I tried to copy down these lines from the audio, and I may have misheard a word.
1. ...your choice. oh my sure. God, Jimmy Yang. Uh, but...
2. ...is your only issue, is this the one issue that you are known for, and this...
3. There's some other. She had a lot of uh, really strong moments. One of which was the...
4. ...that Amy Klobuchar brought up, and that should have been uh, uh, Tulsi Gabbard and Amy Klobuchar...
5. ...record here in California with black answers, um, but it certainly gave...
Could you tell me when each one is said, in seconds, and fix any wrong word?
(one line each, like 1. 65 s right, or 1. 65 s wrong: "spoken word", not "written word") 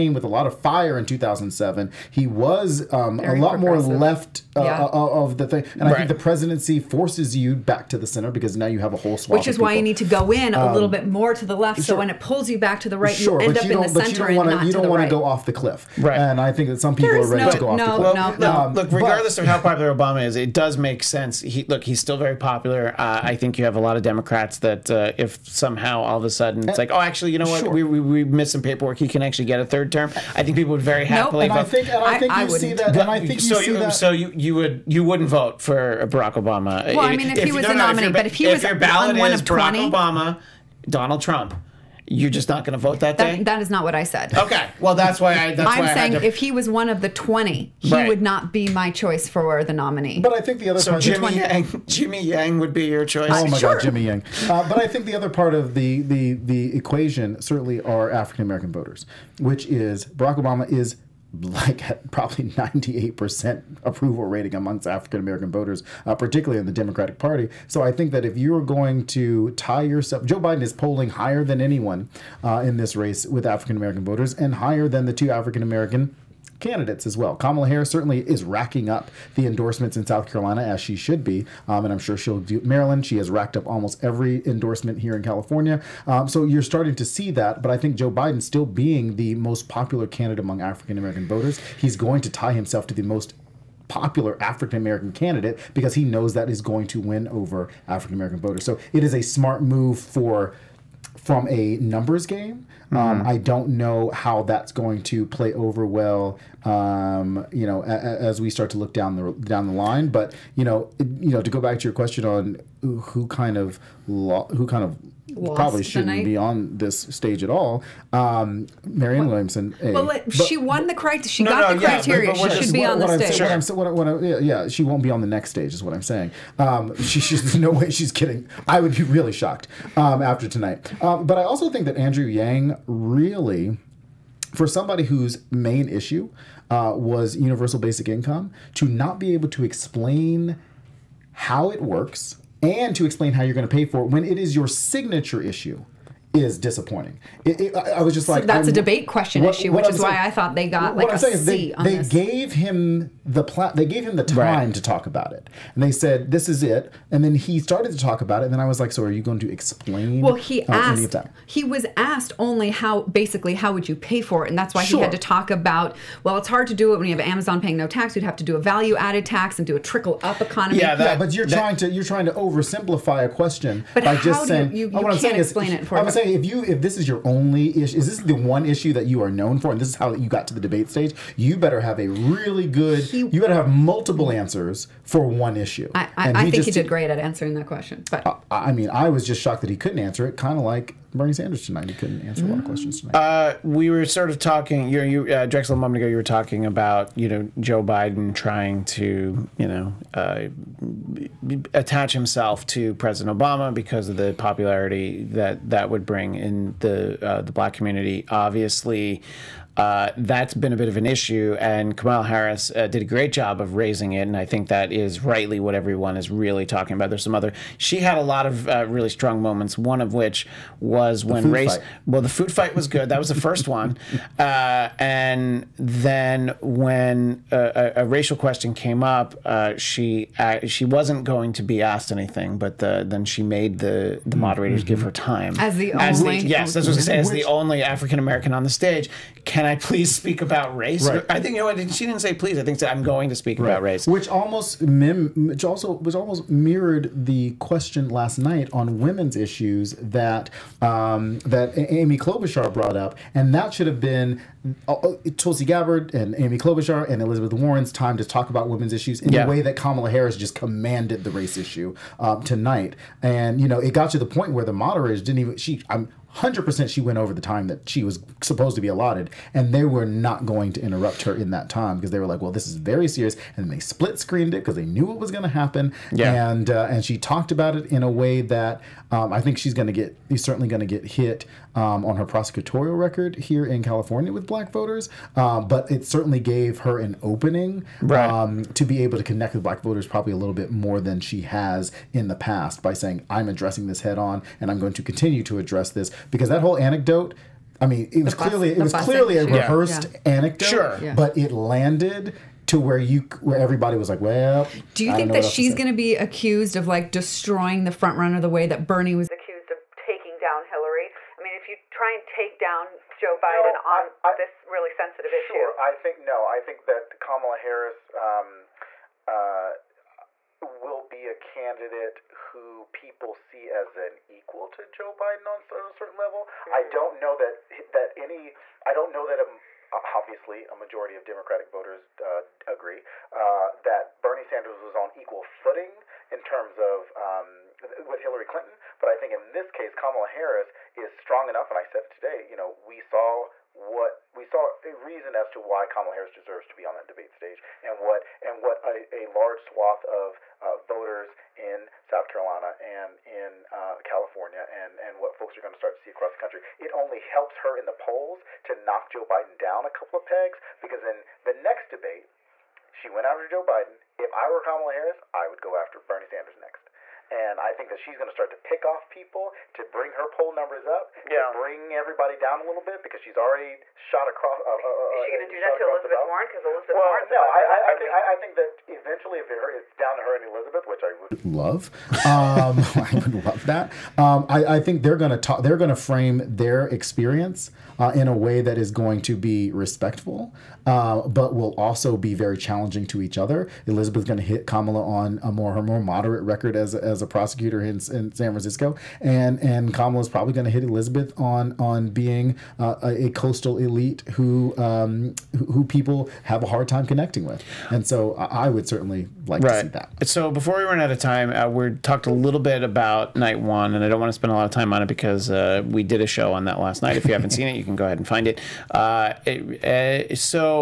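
1. 52 s right
2. 176 s right
3. 217 s right
4. 251 s right
5. 282 s wrong: "voters", not "answers".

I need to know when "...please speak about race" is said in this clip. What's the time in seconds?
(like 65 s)
239 s.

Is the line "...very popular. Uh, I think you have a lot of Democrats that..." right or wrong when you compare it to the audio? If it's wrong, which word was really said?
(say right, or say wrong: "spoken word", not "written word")
right.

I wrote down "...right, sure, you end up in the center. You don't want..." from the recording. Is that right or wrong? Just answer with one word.
right.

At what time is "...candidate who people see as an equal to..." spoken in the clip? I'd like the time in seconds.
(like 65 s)
321 s.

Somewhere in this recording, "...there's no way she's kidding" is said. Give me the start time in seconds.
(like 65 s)
127 s.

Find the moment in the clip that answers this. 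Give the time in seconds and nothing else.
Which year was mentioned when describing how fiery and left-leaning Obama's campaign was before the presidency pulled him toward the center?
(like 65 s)
1 s.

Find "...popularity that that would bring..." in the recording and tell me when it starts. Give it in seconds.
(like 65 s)
204 s.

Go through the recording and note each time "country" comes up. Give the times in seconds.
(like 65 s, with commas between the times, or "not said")
356 s.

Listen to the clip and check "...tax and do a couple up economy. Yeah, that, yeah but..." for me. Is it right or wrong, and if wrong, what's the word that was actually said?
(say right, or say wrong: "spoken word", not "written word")
wrong: "trickle", not "couple".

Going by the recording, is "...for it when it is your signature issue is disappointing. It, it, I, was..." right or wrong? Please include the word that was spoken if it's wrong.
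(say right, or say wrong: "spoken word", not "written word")
right.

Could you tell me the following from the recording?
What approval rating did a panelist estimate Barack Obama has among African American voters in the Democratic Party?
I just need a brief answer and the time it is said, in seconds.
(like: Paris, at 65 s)
98%, at 62 s.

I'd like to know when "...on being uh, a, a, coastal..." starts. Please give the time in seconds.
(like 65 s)
401 s.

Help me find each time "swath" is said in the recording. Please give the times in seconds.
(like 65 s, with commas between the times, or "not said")
9 s, 349 s.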